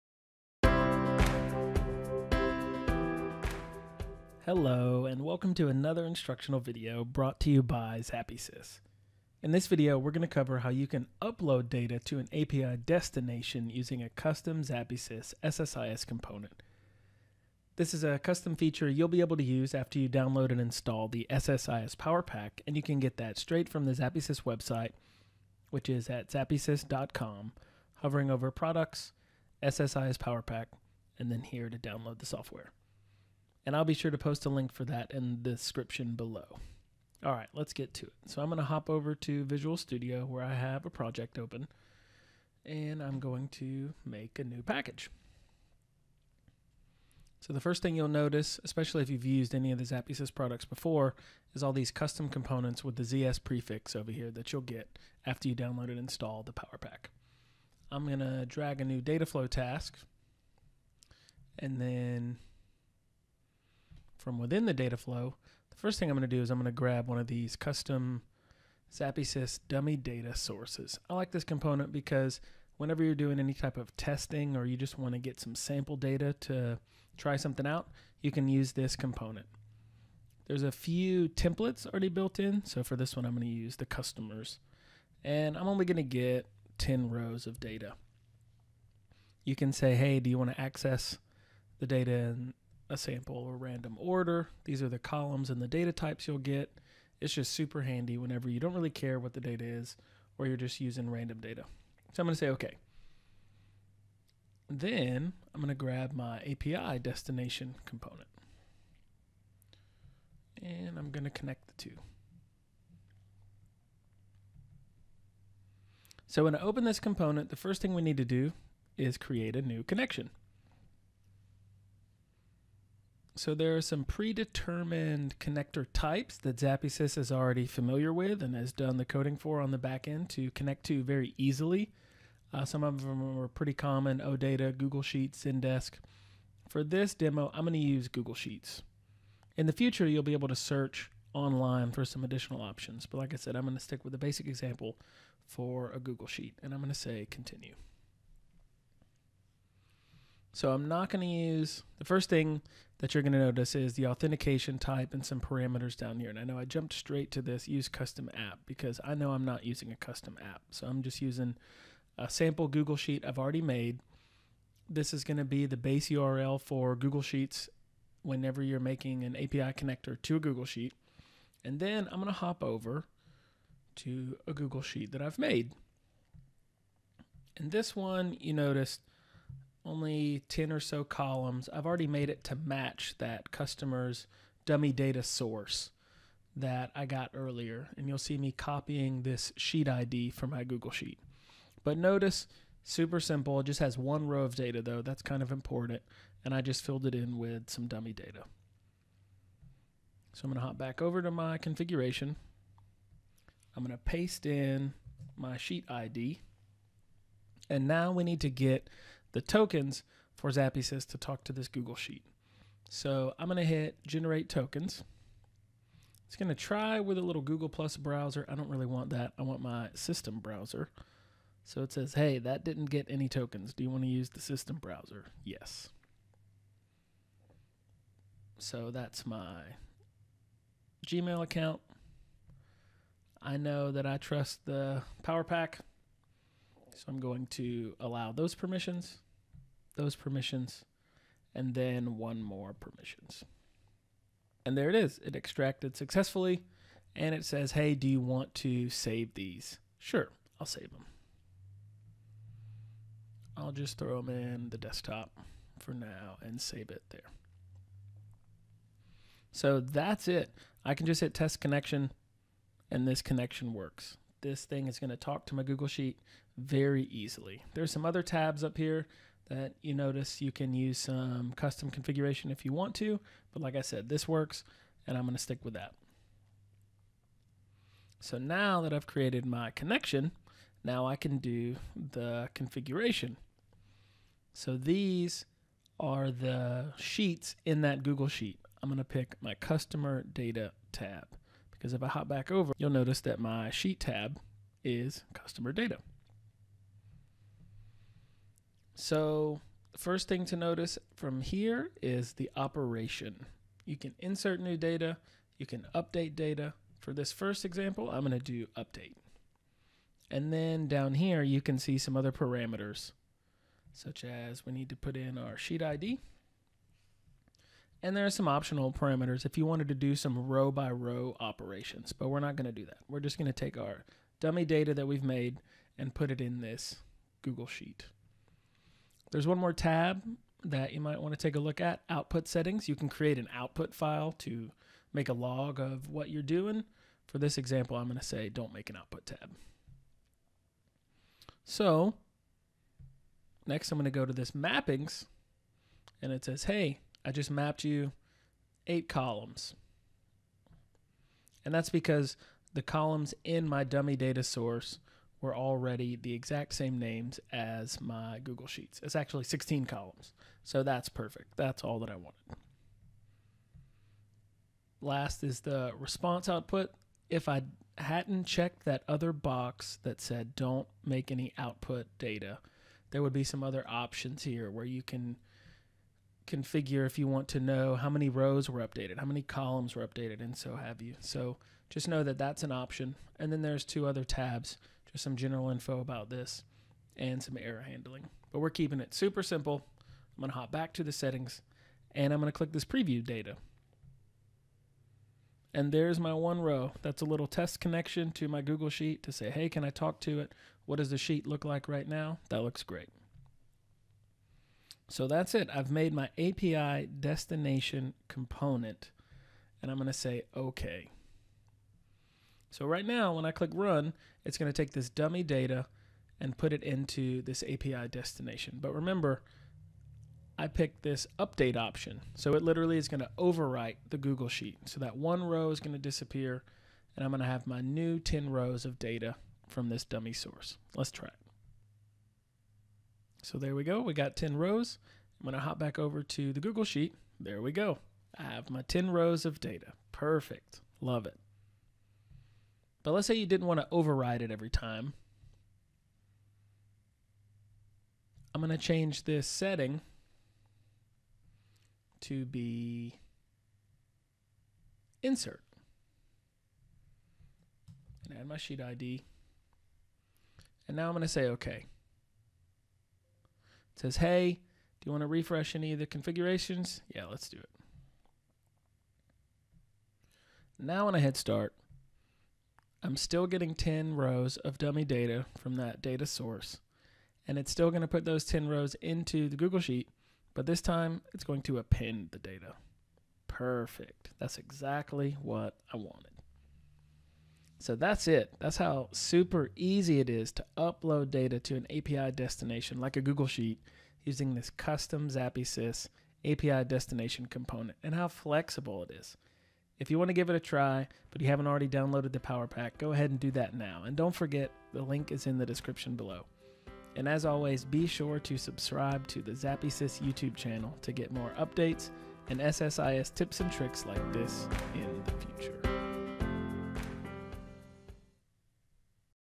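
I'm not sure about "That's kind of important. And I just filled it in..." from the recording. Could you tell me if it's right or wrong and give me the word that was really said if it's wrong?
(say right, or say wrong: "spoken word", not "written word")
right.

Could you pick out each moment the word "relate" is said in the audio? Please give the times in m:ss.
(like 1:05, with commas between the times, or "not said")
not said.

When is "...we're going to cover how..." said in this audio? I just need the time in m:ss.
0:09.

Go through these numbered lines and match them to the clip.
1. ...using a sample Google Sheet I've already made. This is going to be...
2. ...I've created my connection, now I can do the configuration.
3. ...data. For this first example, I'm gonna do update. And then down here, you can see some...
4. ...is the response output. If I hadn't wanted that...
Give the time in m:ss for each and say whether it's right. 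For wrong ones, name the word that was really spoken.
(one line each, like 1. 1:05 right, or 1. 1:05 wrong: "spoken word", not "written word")
1. 2:41 right
2. 4:38 right
3. 5:06 right
4. 6:05 wrong: "checked", not "wanted".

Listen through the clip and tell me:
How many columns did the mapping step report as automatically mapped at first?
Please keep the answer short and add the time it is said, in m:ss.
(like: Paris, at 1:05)
8, at 5:48.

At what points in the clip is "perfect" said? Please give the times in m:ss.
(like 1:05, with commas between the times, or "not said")
6:01, 7:20, 8:03.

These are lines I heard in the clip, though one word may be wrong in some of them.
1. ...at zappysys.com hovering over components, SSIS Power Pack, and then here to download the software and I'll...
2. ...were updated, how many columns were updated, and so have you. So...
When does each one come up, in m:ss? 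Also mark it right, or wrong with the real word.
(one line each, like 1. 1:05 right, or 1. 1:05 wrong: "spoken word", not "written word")
1. 0:26 wrong: "products", not "components"
2. 6:18 right.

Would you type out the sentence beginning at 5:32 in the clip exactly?
You can create an output file to make a log of what you're doing.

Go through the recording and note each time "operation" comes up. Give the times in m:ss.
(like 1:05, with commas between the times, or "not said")
5:02, 5:21.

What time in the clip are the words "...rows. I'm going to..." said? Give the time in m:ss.
7:14.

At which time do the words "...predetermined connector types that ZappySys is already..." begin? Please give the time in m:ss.
2:04.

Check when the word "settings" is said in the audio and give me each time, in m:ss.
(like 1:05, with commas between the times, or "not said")
5:32, 6:31, 7:29.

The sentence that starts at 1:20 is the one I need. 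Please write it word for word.
There's a few templates already built in, so for this one I'm going to use the customers.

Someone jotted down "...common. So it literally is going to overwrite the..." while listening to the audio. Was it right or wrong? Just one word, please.
wrong.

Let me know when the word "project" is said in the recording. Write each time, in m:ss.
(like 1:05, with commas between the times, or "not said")
0:40.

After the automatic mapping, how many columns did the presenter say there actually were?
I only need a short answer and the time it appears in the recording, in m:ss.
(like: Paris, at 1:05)
16, at 5:59.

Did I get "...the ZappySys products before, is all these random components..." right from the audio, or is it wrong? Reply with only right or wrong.
wrong.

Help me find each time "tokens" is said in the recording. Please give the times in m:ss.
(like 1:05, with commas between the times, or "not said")
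3:29, 3:34, 3:43.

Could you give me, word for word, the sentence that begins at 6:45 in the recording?
I've made my API destination component and I'm going to say OK.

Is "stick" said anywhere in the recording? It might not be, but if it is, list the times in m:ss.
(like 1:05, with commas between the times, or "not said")
2:23, 4:35.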